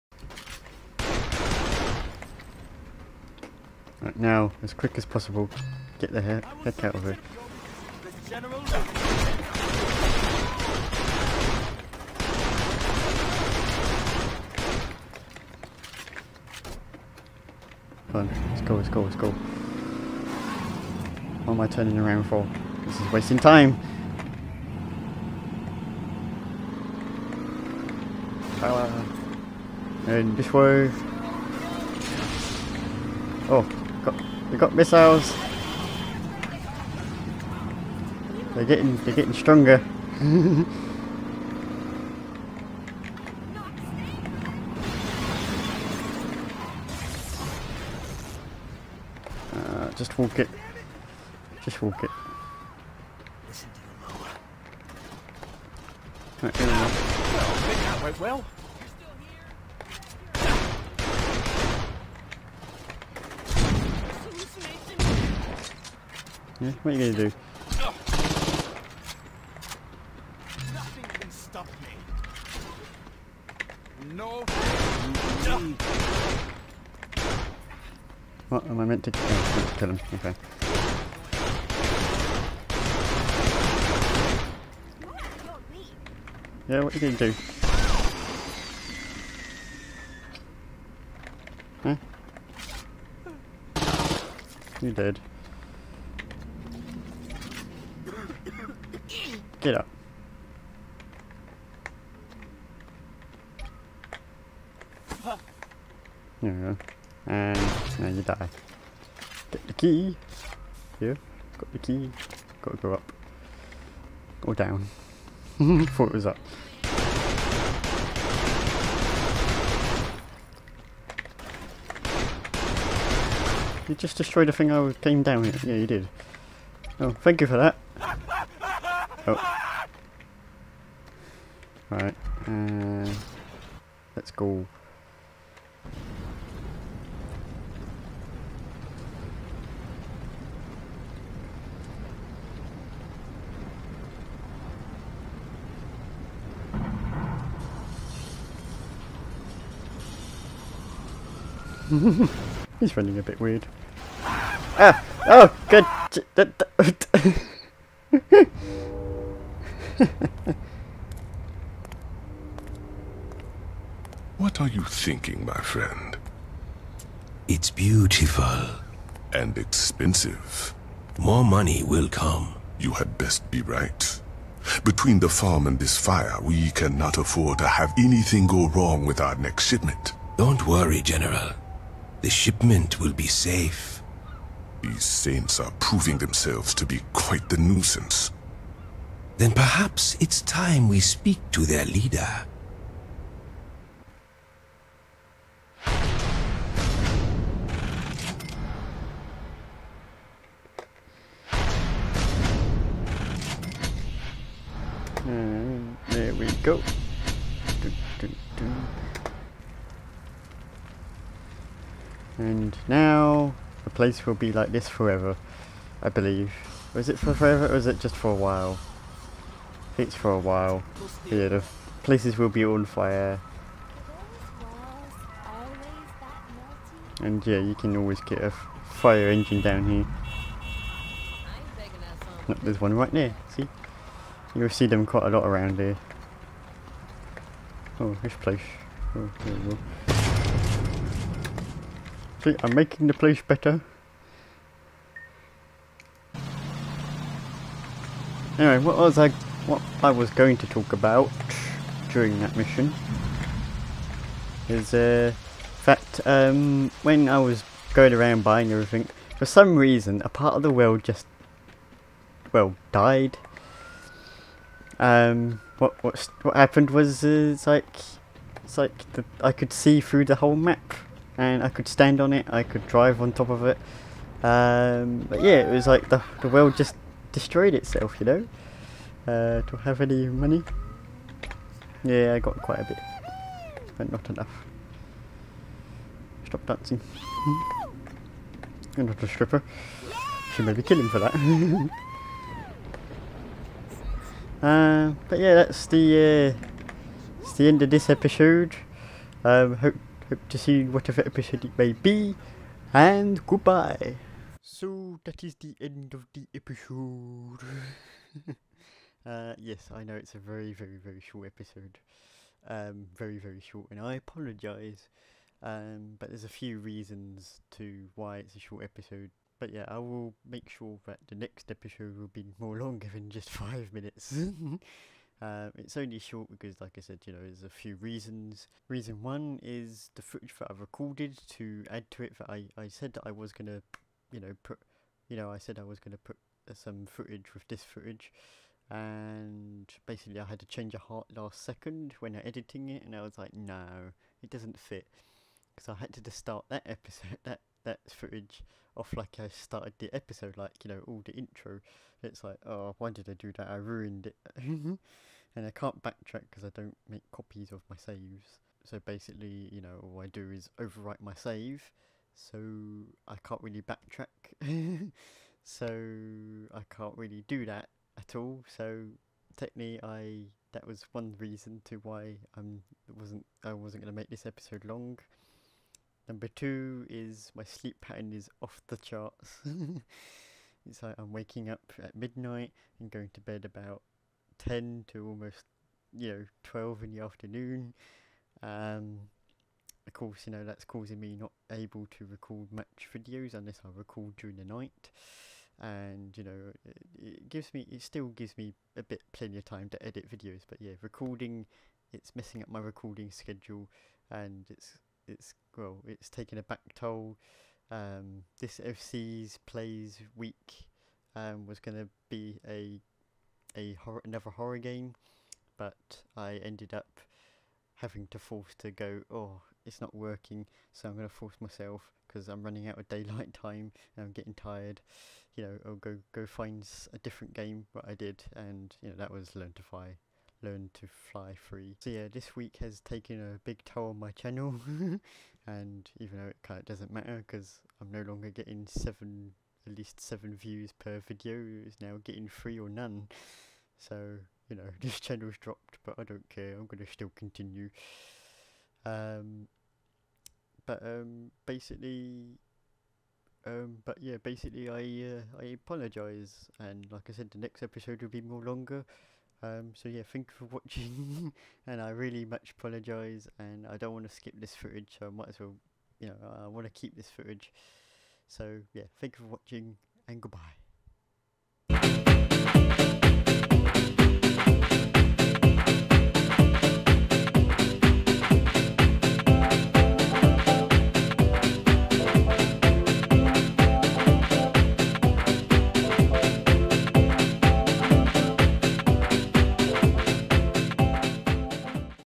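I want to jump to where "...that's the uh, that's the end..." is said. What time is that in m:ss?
4:55.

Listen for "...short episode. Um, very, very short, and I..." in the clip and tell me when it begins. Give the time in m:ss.
5:11.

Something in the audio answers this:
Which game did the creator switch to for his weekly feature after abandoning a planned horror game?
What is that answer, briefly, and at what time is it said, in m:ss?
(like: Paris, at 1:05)
Learn to Fly Free, at 7:10.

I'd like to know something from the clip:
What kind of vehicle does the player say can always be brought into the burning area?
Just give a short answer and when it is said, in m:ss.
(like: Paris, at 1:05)
A fire engine, at 3:48.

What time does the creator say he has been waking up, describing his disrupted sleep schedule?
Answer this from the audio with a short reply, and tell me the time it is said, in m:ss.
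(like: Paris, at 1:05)
Midnight, at 6:22.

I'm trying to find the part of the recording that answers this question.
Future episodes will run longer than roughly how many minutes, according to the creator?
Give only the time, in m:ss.
5:23.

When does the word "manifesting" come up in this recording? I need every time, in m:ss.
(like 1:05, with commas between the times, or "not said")
not said.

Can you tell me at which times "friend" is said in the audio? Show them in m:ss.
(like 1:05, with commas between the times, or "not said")
2:45.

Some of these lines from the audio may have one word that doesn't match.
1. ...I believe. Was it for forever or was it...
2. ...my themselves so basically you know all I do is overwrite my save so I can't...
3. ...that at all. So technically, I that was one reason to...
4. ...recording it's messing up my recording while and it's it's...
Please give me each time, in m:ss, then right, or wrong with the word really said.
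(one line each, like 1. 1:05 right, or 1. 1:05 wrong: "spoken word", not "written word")
1. 3:36 right
2. 5:57 wrong: "saves", not "themselves"
3. 6:07 right
4. 6:41 wrong: "schedule", not "while".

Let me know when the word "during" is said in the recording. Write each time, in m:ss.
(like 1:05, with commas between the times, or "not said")
4:12, 6:34.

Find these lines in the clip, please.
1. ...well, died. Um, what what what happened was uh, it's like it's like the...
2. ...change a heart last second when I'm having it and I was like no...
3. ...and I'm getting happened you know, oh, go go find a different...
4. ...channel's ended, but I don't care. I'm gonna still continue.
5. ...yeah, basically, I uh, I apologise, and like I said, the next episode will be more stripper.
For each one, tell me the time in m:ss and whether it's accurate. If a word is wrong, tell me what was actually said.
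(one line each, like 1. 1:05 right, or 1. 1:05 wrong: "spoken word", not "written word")
1. 4:22 right
2. 5:40 wrong: "editing", not "having"
3. 7:04 wrong: "tired", not "happened"
4. 7:25 wrong: "dropped", not "ended"
5. 7:34 wrong: "longer", not "stripper".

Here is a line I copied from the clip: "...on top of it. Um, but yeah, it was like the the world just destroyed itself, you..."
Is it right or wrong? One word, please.
right.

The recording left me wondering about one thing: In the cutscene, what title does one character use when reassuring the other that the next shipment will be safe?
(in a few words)
General.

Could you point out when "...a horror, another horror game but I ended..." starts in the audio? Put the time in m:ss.
6:53.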